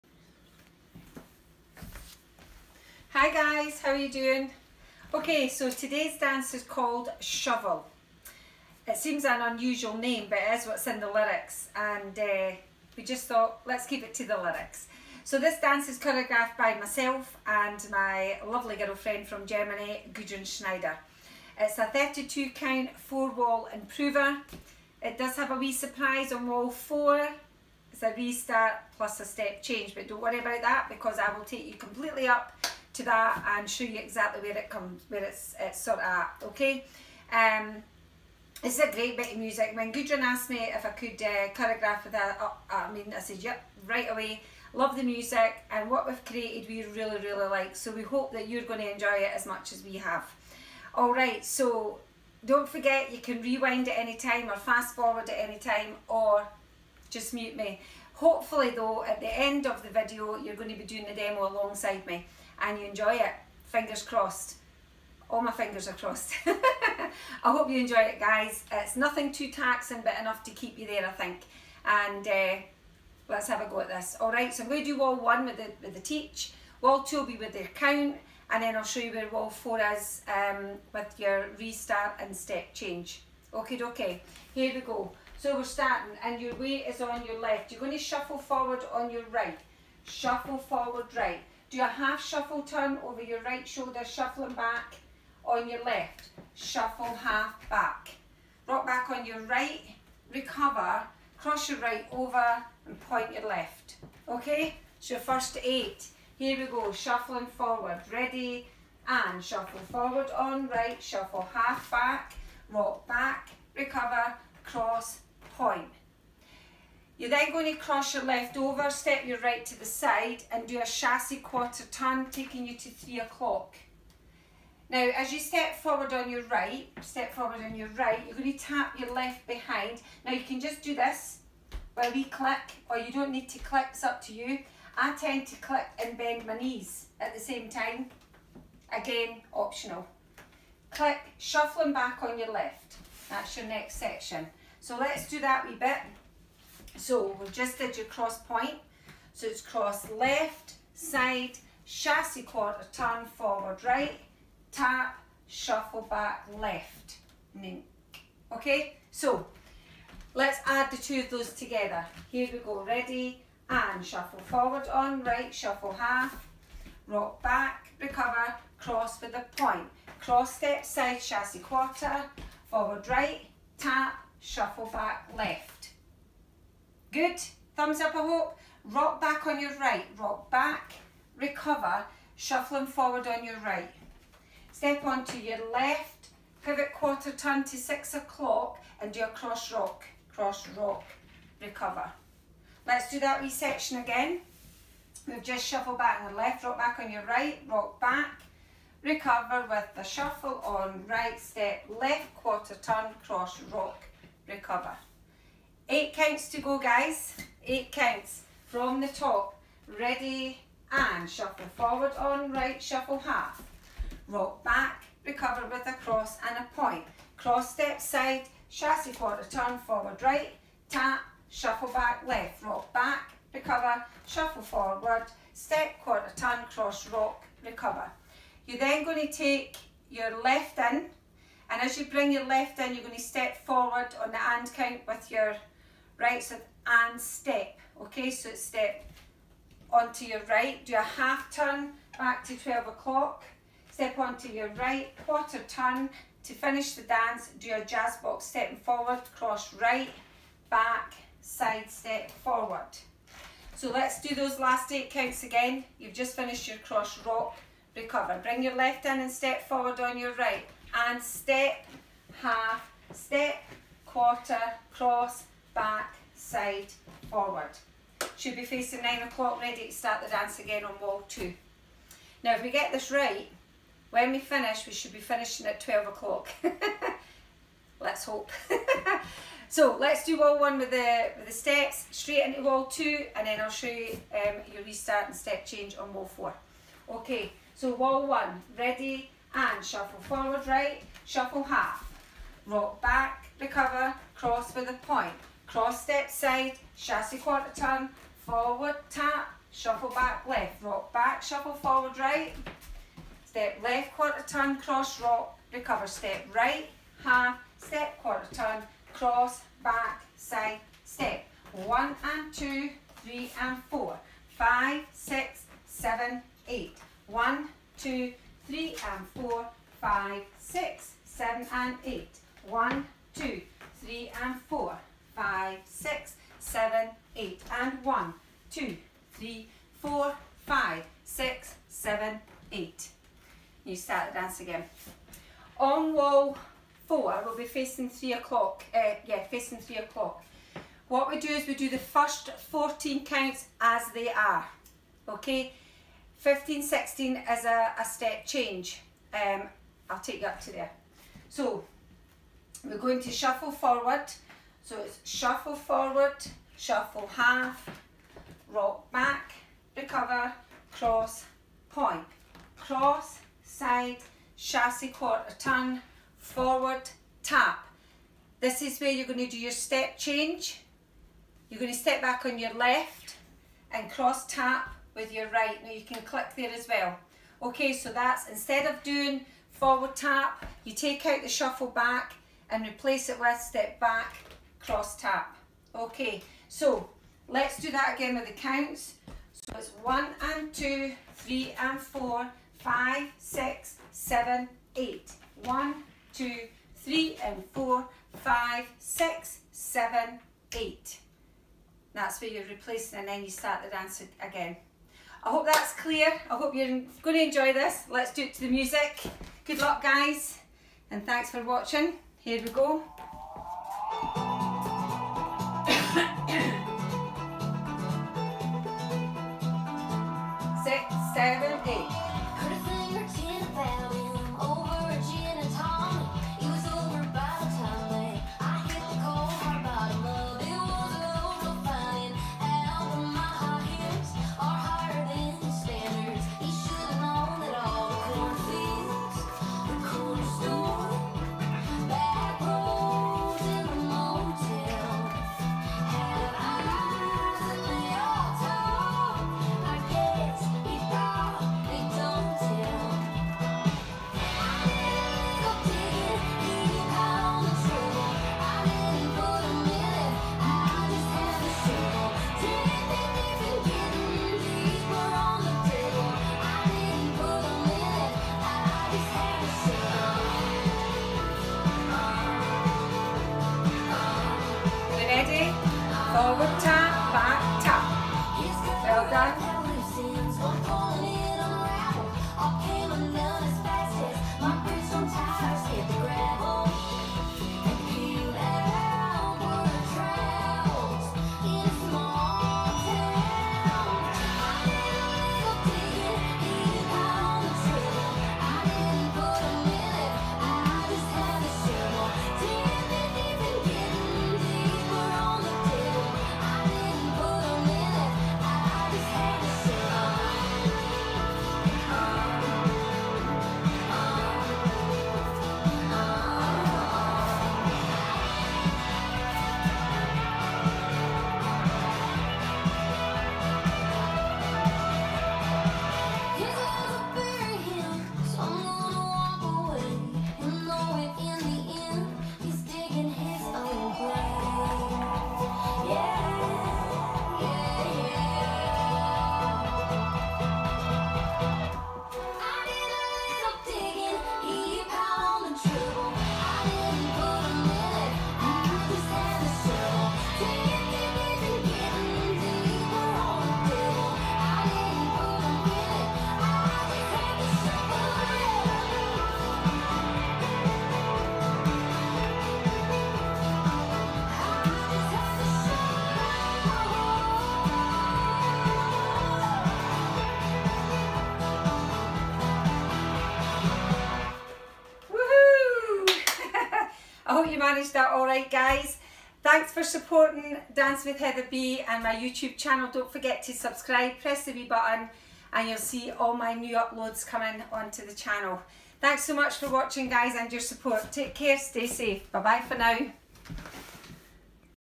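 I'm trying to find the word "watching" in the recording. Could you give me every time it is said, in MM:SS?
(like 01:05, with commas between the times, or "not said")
06:51, 09:49.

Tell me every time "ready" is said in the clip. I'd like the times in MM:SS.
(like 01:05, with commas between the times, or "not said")
01:48, 02:42, 03:29, 04:29, 04:48.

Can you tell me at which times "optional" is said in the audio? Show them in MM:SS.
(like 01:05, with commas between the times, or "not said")
02:19.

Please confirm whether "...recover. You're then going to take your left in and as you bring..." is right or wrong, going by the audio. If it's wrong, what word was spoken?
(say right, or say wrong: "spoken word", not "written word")
right.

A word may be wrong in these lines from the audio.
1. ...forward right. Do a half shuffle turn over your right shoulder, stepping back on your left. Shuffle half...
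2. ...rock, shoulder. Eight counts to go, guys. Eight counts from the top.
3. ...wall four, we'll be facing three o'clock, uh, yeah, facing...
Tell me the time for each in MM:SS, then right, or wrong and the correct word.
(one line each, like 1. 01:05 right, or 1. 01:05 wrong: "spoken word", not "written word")
1. 01:30 wrong: "shuffling", not "stepping"
2. 03:23 wrong: "recover", not "shoulder"
3. 05:36 right.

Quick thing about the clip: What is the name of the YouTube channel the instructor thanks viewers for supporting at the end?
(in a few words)
Dance with Heather B.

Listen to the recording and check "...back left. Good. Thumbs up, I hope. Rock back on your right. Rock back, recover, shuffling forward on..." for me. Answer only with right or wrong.
right.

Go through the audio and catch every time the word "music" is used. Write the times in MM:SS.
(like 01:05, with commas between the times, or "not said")
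00:39, 00:45, 06:48.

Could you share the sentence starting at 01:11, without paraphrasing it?
And uh, let's have a go at this.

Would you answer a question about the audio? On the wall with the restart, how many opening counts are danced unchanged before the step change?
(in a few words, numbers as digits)
14.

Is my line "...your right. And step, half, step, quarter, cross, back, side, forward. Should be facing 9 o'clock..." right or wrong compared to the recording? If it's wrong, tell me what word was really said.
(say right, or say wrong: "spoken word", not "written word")
right.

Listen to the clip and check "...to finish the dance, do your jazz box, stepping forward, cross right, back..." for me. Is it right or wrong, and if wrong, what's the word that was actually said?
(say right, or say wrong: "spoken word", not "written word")
right.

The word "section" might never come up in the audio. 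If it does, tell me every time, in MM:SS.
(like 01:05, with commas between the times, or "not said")
02:23, 03:13.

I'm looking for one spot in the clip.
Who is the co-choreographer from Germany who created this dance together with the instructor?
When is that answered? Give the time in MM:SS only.
00:20.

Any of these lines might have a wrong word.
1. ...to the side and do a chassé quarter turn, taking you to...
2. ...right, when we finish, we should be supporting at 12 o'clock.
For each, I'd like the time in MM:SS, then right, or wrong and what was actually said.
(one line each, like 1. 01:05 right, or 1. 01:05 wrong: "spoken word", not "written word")
1. 01:59 right
2. 04:33 wrong: "finishing", not "supporting".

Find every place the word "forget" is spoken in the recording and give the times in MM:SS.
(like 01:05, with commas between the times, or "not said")
00:52, 09:43.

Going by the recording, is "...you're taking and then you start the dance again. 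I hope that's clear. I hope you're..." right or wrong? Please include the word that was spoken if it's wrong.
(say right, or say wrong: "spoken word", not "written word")
wrong: "replacing", not "taking".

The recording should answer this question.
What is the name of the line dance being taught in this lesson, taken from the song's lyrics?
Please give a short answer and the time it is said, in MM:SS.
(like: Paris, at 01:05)
Shovel, at 00:07.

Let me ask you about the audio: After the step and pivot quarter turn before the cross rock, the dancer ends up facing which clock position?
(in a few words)
6 o'clock.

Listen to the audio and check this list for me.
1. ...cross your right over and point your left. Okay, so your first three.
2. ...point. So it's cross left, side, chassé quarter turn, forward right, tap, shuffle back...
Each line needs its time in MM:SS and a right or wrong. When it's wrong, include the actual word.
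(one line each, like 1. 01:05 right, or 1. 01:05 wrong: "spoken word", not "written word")
1. 01:41 wrong: "eight", not "three"
2. 02:28 right.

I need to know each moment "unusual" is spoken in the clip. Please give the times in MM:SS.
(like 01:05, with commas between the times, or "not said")
00:09.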